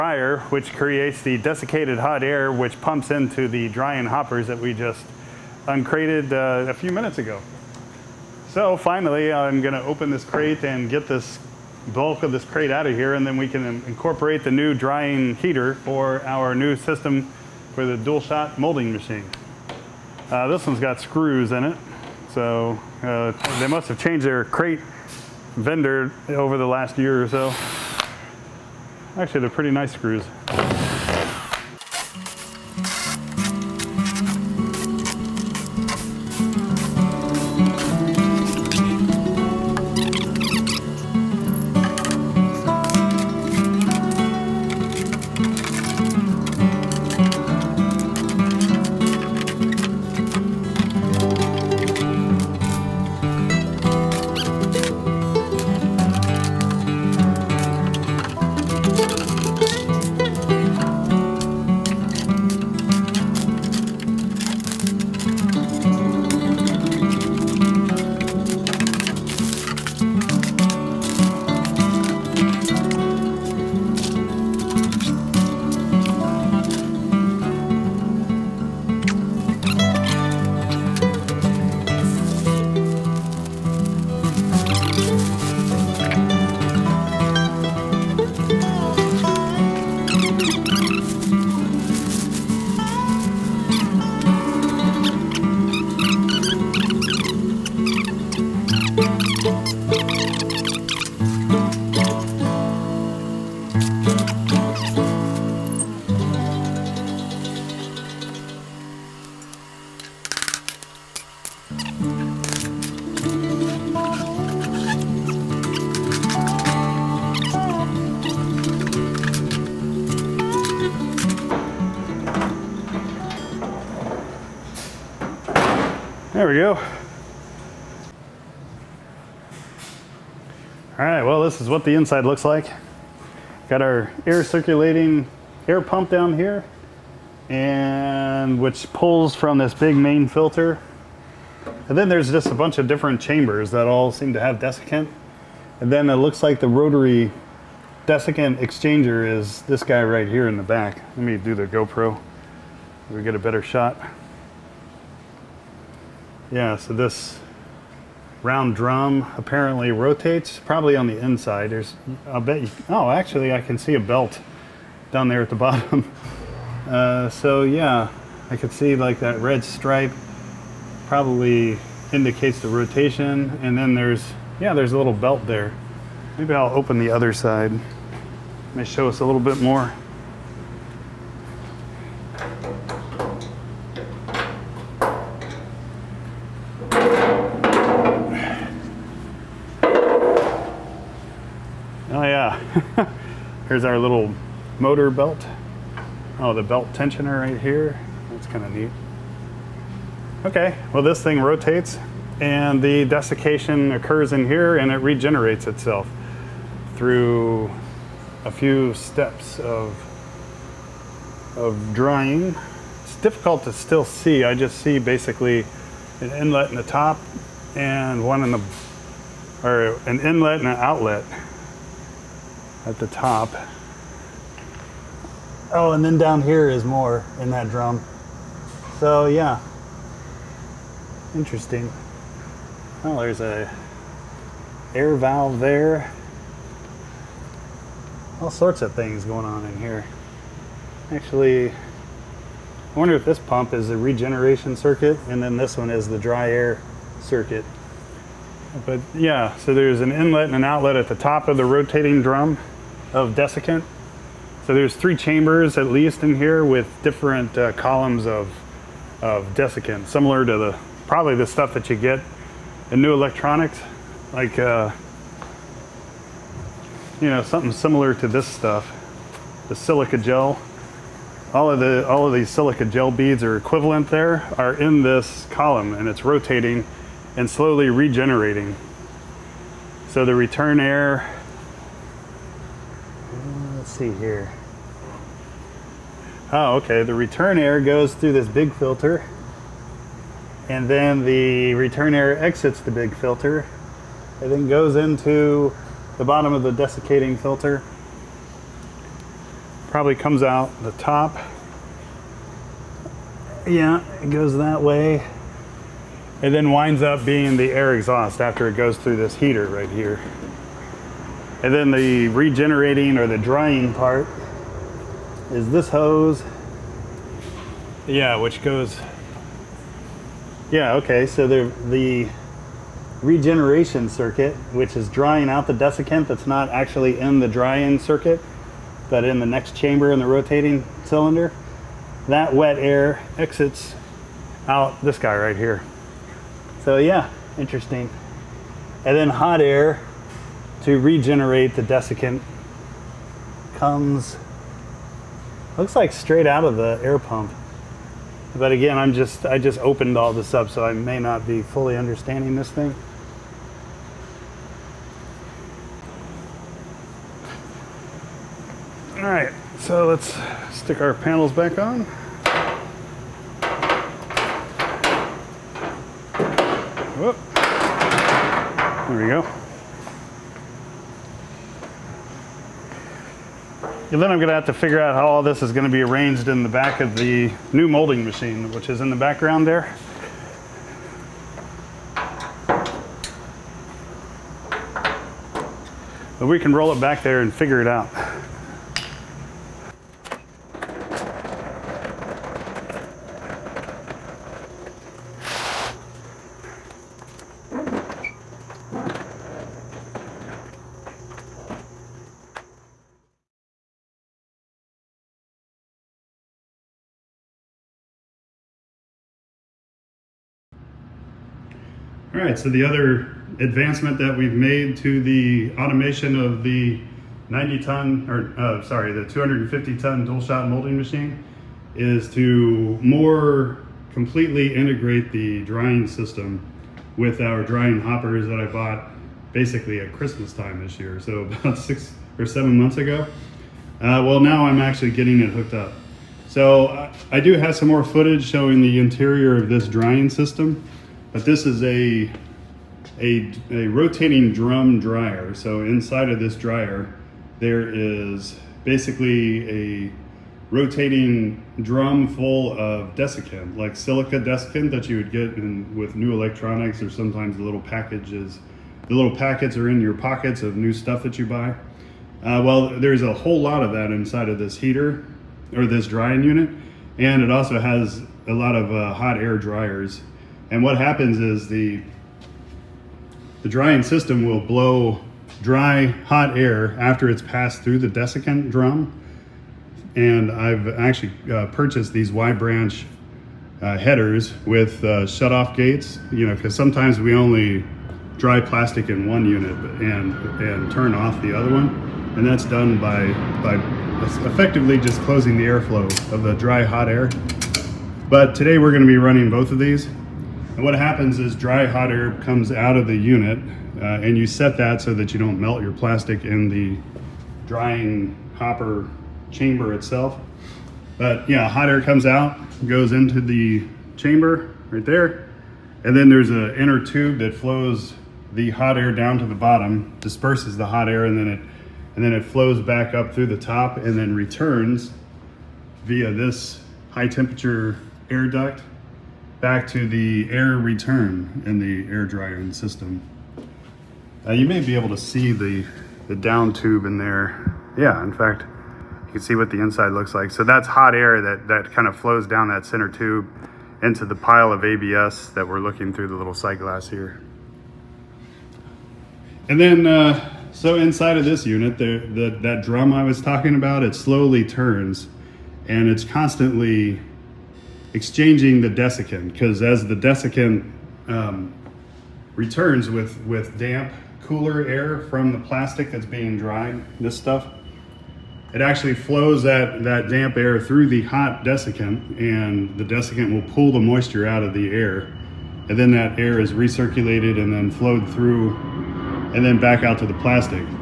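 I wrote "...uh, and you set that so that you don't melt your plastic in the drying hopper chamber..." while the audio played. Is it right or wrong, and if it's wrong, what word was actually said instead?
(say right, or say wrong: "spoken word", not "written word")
right.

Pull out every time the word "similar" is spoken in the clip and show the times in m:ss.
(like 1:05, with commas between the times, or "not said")
4:20, 4:27.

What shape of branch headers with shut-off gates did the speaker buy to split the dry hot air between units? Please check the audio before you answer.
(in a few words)
Y branch.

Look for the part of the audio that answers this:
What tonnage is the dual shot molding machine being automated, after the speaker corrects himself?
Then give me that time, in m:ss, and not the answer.
6:59.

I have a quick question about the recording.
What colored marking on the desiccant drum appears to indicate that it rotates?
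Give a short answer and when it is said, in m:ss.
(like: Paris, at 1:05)
Red stripe, at 2:49.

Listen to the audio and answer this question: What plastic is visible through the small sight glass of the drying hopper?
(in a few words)
ABS.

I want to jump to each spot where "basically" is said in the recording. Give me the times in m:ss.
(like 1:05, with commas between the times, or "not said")
3:34, 7:09, 7:28.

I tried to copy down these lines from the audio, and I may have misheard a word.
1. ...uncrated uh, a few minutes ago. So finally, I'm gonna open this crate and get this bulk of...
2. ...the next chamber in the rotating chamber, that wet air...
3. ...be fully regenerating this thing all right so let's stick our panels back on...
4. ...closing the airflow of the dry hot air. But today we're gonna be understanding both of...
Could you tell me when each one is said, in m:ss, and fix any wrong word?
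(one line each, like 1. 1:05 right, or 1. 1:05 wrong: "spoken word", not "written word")
1. 0:05 right
2. 5:29 wrong: "cylinder", not "chamber"
3. 5:51 wrong: "understanding", not "regenerating"
4. 8:15 wrong: "running", not "understanding".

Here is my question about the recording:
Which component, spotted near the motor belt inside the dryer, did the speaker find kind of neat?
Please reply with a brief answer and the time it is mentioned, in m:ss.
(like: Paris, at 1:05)
Belt tensioner, at 3:16.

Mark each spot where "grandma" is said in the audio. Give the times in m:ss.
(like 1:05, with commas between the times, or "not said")
not said.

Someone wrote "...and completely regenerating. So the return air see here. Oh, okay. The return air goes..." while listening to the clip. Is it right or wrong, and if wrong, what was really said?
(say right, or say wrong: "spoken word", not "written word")
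wrong: "slowly", not "completely".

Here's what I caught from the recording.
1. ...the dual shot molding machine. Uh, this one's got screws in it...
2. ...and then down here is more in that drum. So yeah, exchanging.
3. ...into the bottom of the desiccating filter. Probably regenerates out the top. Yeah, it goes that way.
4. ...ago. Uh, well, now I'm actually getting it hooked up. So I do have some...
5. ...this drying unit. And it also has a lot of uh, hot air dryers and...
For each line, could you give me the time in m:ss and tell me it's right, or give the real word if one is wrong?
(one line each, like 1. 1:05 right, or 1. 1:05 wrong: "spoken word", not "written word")
1. 0:17 right
2. 3:45 wrong: "interesting", not "exchanging"
3. 4:54 wrong: "comes", not "regenerates"
4. 7:12 right
5. 7:45 right.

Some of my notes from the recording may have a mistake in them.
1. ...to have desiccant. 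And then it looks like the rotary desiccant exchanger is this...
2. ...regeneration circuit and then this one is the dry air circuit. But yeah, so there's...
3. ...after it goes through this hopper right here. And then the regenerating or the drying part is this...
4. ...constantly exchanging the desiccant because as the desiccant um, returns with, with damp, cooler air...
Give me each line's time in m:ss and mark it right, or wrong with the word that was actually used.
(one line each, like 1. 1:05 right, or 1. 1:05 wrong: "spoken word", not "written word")
1. 2:24 right
2. 4:03 right
3. 5:08 wrong: "heater", not "hopper"
4. 9:16 right.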